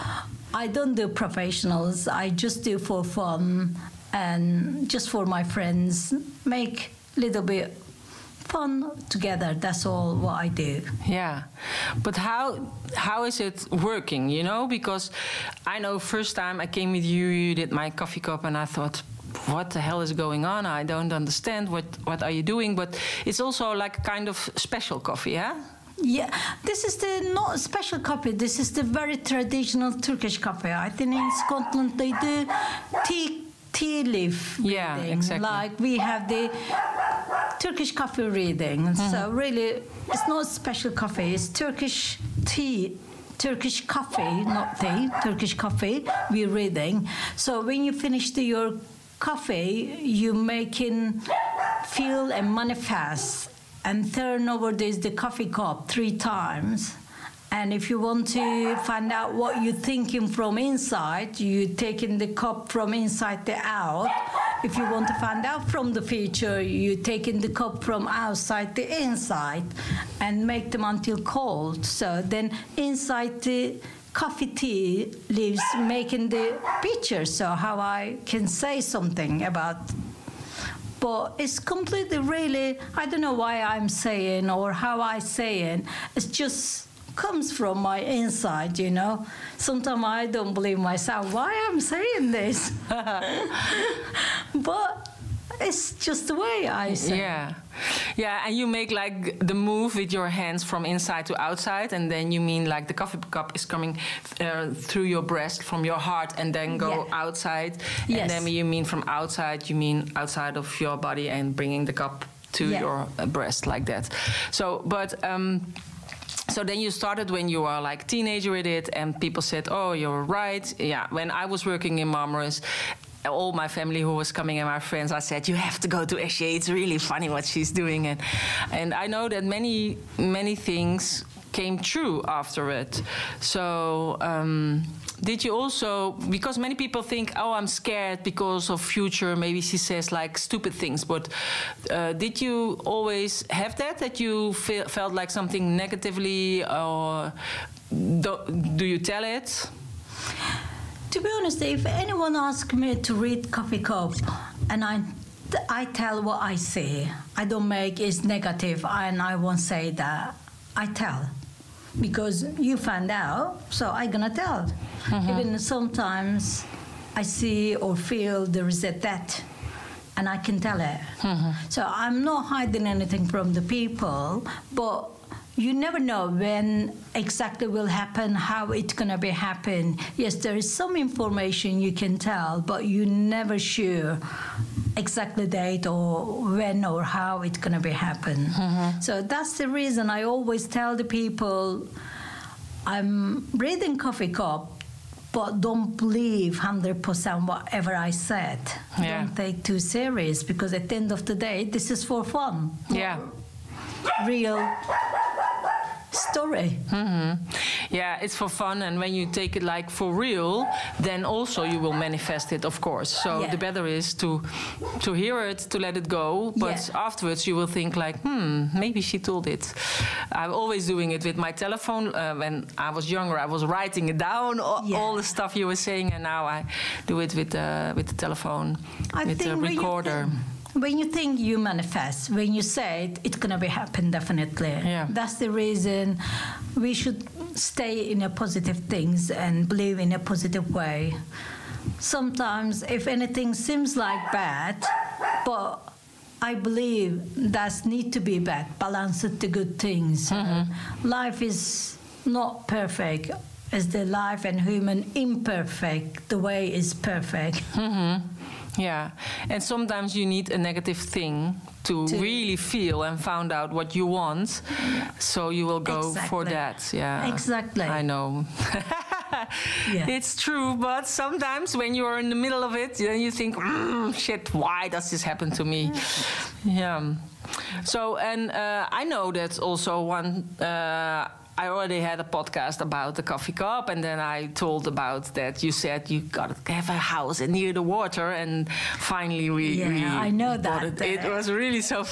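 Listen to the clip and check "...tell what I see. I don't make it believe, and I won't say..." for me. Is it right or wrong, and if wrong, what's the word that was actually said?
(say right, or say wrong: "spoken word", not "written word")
wrong: "negative", not "believe".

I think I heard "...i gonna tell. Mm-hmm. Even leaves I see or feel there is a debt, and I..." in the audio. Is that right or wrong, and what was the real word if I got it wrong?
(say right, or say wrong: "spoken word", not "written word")
wrong: "sometimes", not "leaves".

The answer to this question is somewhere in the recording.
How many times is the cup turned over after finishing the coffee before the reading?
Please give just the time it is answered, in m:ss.
0:55.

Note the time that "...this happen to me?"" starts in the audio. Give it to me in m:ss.
4:35.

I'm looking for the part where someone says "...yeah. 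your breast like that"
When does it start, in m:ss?
1:52.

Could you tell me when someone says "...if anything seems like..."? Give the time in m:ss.
4:02.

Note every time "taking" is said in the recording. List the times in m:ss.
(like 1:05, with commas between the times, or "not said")
1:01, 1:07.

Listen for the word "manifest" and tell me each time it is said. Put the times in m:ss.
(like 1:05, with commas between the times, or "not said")
0:52, 3:31, 3:51.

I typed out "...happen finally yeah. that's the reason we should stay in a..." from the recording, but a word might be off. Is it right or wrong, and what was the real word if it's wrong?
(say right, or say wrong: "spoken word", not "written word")
wrong: "definitely", not "finally".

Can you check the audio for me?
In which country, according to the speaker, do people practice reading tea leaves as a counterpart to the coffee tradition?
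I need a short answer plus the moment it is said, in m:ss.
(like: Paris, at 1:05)
Scotland, at 0:31.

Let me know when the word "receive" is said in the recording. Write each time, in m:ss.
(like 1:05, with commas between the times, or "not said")
not said.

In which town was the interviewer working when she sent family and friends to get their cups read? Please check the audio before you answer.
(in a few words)
Marmaris.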